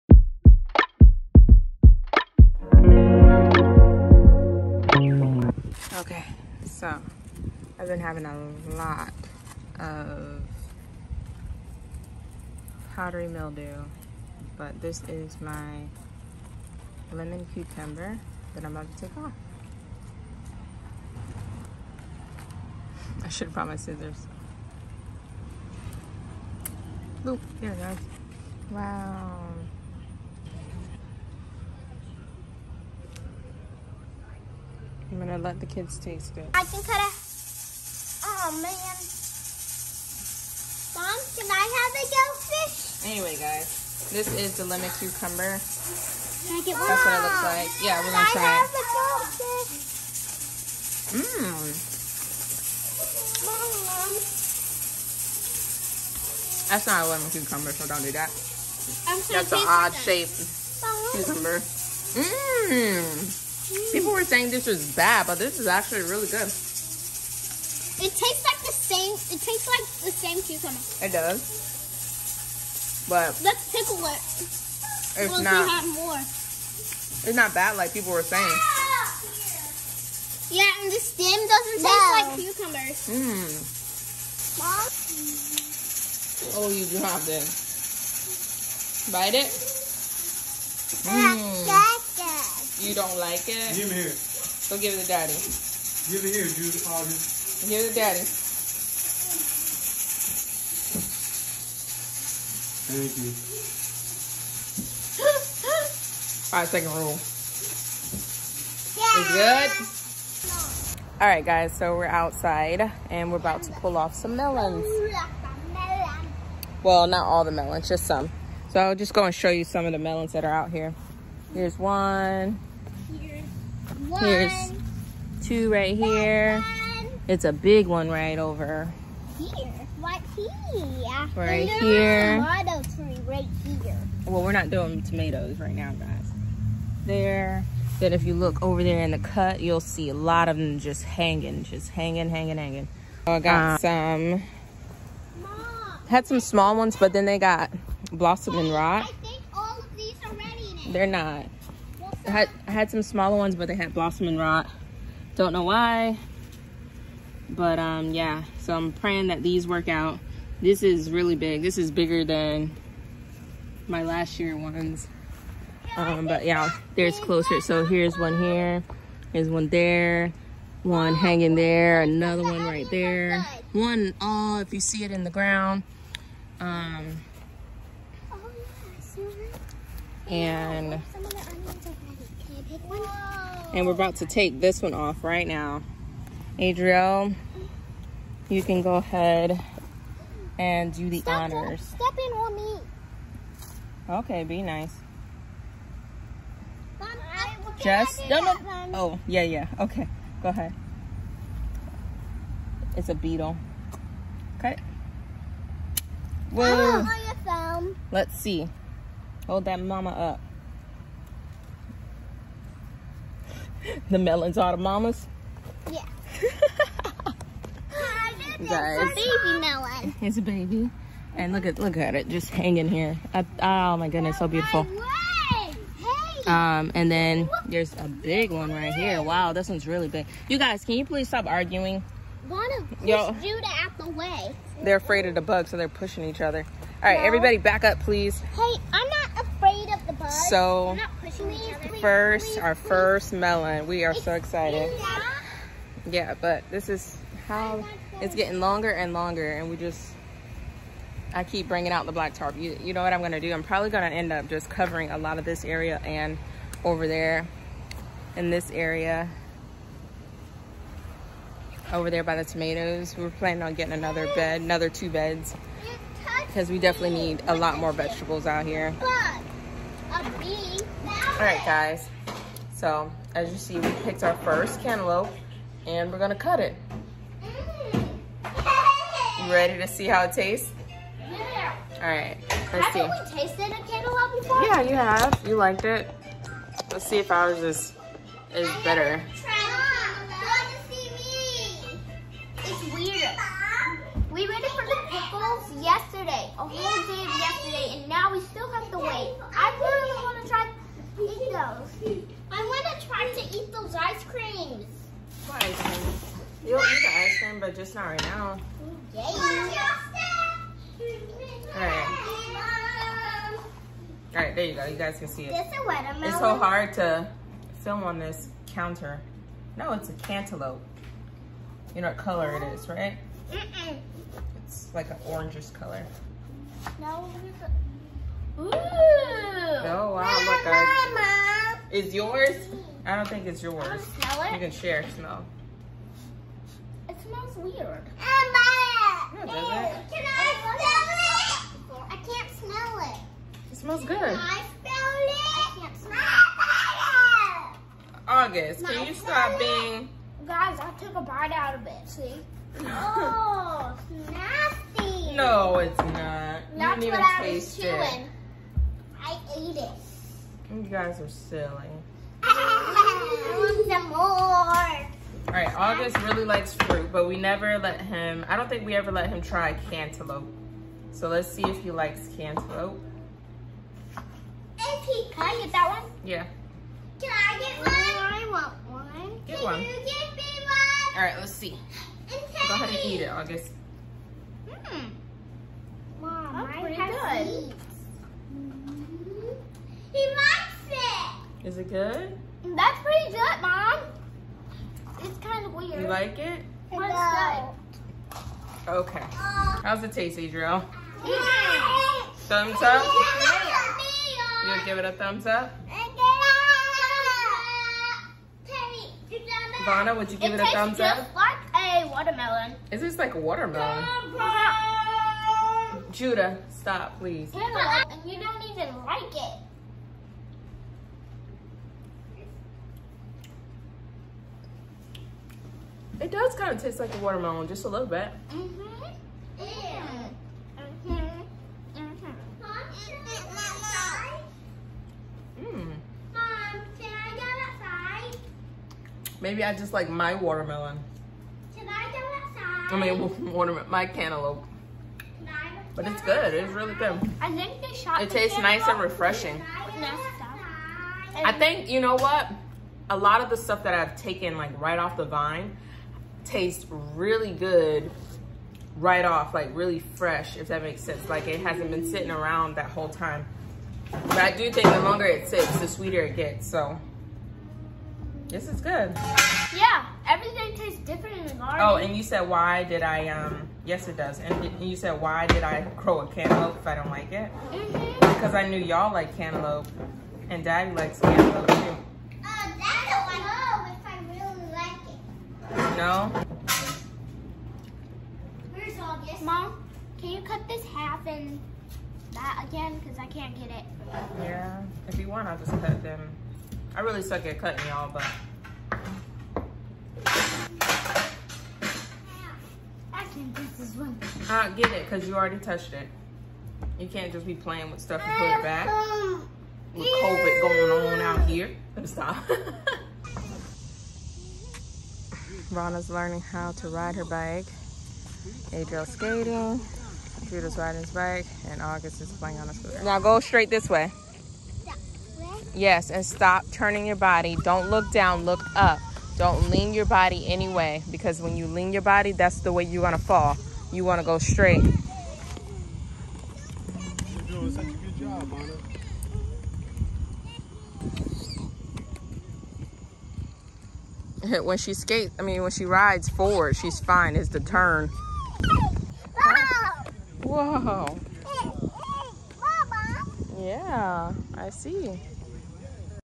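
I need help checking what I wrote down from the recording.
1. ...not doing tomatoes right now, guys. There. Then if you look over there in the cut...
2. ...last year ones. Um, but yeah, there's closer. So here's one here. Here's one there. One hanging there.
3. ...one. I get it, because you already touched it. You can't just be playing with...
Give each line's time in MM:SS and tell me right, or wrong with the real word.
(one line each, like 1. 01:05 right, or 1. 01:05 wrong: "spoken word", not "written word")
1. 02:14 right
2. 02:44 right
3. 08:23 right.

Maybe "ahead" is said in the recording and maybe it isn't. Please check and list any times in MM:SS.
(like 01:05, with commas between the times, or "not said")
03:08, 03:20, 06:22.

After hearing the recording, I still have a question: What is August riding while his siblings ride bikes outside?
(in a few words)
a scooter.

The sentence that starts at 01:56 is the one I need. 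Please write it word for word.
Well, not all the melons, just some.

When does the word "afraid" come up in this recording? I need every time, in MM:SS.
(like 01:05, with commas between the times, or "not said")
03:54, 03:59.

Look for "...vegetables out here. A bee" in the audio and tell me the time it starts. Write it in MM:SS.
04:27.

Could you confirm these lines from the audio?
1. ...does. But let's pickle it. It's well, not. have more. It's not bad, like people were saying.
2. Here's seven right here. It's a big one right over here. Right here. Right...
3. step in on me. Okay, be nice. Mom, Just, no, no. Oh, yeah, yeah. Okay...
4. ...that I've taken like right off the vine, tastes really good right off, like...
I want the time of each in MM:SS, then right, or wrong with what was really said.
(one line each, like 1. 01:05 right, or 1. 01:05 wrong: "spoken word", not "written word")
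1. 01:11 right
2. 02:04 wrong: "two", not "seven"
3. 03:11 right
4. 07:33 right.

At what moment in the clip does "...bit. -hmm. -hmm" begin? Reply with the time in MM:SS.
07:08.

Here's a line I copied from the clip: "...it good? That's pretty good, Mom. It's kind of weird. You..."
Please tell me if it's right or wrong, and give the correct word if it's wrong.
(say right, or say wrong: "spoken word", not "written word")
right.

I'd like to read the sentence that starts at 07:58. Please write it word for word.
Because I knew y'all like cantaloupe and daddy likes cantaloupe too.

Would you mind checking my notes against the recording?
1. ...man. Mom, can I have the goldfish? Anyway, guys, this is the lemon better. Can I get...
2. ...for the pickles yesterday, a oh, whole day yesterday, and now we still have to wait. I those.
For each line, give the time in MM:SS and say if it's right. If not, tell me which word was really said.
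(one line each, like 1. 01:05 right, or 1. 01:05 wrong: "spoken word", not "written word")
1. 00:38 wrong: "cucumber", not "better"
2. 04:54 right.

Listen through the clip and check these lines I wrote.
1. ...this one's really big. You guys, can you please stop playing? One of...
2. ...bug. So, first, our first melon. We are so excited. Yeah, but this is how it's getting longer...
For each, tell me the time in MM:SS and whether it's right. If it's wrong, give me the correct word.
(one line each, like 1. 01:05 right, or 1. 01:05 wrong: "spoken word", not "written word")
1. 03:49 wrong: "arguing", not "playing"
2. 04:00 right.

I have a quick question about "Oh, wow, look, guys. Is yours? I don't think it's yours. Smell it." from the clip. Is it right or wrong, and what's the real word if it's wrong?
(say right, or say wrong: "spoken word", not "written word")
right.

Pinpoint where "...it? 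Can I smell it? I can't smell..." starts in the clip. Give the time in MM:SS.
05:39.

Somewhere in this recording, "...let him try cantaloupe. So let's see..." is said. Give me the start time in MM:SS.
06:09.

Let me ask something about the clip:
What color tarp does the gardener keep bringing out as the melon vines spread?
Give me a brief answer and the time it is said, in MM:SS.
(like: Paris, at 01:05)
black, at 04:12.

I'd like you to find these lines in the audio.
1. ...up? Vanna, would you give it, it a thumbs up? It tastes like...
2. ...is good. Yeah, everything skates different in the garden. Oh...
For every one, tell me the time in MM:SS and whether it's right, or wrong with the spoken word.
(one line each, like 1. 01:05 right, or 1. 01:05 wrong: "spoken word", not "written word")
1. 06:45 right
2. 07:48 wrong: "tastes", not "skates".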